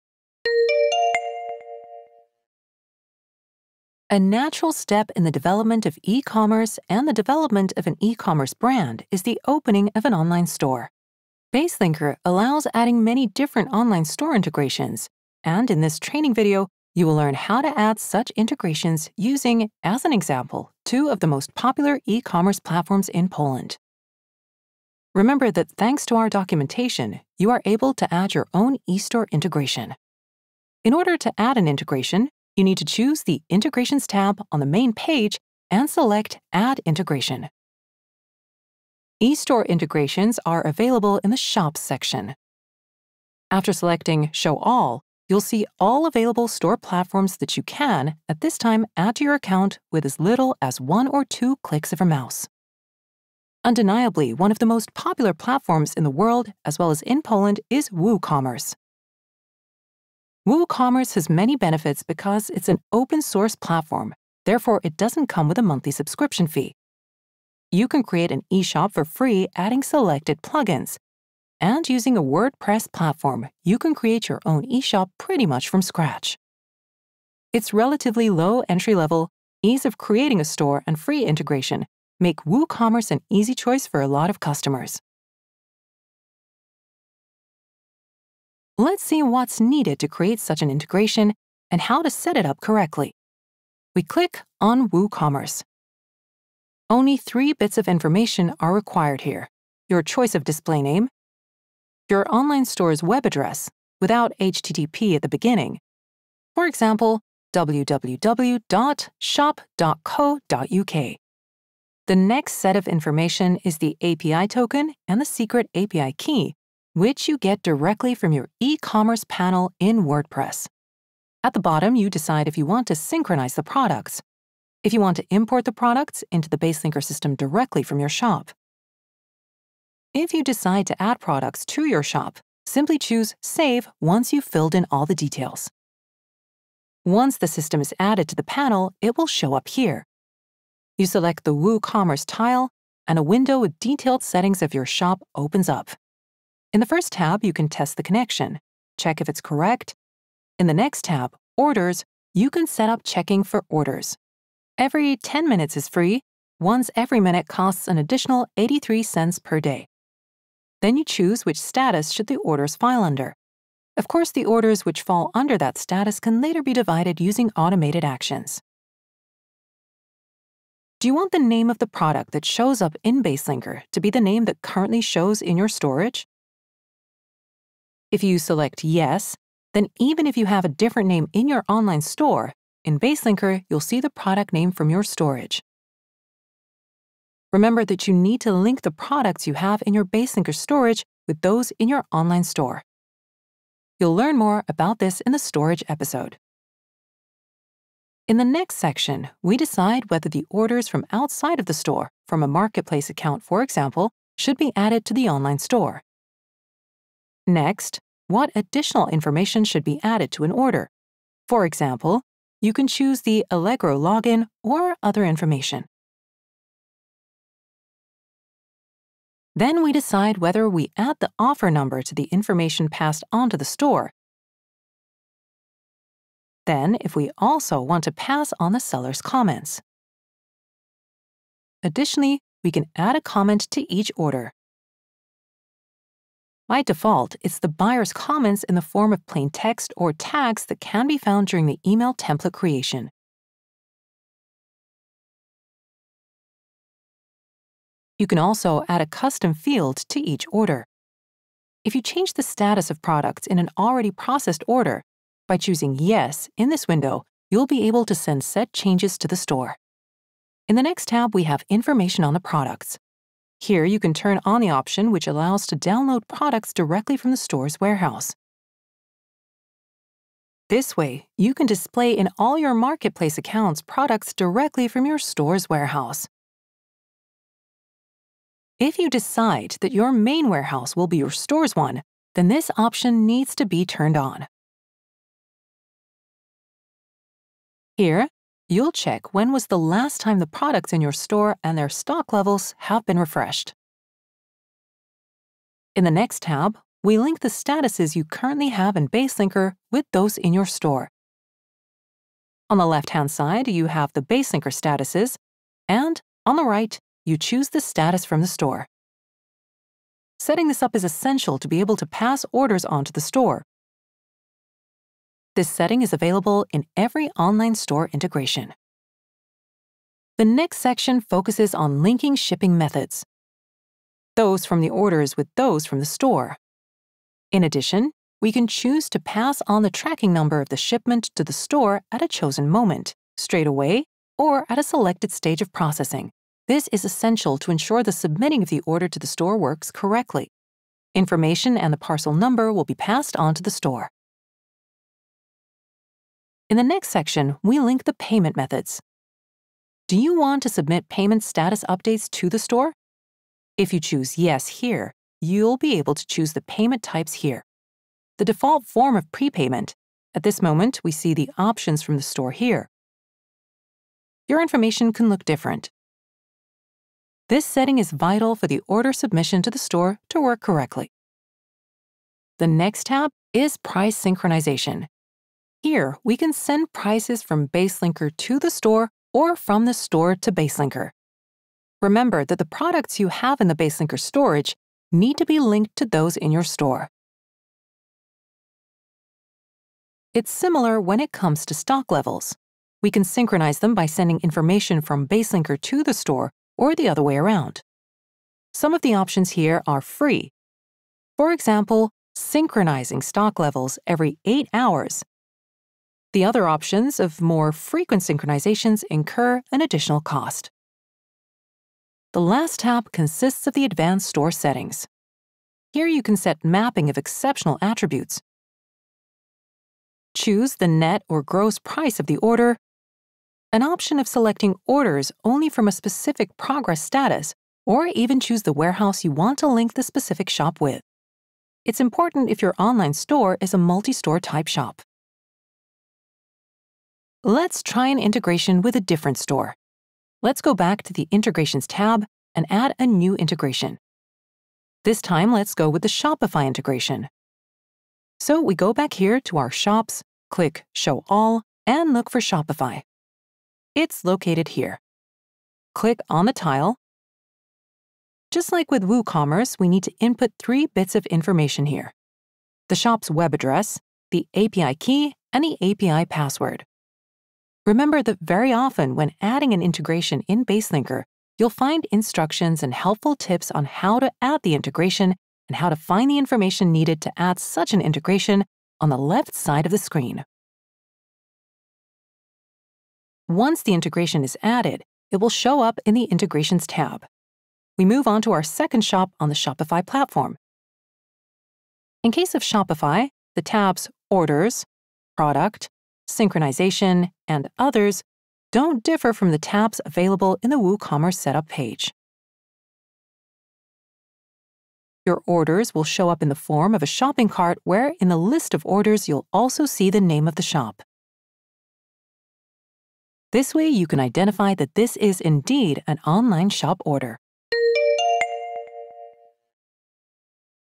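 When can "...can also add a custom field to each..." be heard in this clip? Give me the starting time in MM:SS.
04:08.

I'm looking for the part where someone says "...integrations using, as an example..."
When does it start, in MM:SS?
00:18.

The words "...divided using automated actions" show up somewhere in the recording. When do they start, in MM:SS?
02:46.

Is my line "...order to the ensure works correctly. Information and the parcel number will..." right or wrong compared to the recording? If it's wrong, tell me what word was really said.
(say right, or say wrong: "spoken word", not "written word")
wrong: "store", not "ensure".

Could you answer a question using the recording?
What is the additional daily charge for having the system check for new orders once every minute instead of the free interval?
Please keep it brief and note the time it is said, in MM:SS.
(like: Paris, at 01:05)
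83 cents, at 02:38.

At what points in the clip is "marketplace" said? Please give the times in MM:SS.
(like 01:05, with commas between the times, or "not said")
03:22, 04:32.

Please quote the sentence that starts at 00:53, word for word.
Undeniably, one of the most popular platforms in the world, as well as in Poland, is WooCommerce.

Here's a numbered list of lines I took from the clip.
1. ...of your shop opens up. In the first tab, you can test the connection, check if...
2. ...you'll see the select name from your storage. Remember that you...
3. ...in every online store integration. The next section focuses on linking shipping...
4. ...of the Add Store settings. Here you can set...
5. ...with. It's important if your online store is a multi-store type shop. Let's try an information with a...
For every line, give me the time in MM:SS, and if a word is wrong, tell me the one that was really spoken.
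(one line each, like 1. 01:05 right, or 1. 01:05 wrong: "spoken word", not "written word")
1. 02:24 right
2. 03:03 wrong: "product", not "select"
3. 05:16 right
4. 06:53 wrong: "Advanced", not "Add"
5. 07:10 wrong: "integration", not "information".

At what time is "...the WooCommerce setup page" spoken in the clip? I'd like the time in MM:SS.
08:20.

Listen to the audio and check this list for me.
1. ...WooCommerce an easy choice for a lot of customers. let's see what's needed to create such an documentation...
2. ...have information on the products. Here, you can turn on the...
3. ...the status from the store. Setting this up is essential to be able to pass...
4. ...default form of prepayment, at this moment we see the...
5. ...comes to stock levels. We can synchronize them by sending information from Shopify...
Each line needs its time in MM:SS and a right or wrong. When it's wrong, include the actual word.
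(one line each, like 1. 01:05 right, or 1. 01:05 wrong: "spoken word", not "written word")
1. 01:22 wrong: "integration", not "documentation"
2. 04:21 right
3. 05:07 right
4. 05:58 right
5. 06:31 wrong: "Baselinker", not "Shopify".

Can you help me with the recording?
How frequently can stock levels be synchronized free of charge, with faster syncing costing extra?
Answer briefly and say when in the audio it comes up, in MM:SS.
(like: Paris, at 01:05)
every 8 hours, at 06:44.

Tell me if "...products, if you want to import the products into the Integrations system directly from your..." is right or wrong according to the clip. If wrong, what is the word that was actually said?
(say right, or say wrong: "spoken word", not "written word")
wrong: "Baselinker", not "Integrations".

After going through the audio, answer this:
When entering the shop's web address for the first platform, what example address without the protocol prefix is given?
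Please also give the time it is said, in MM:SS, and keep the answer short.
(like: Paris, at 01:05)
www.shop.co.uk, at 01:47.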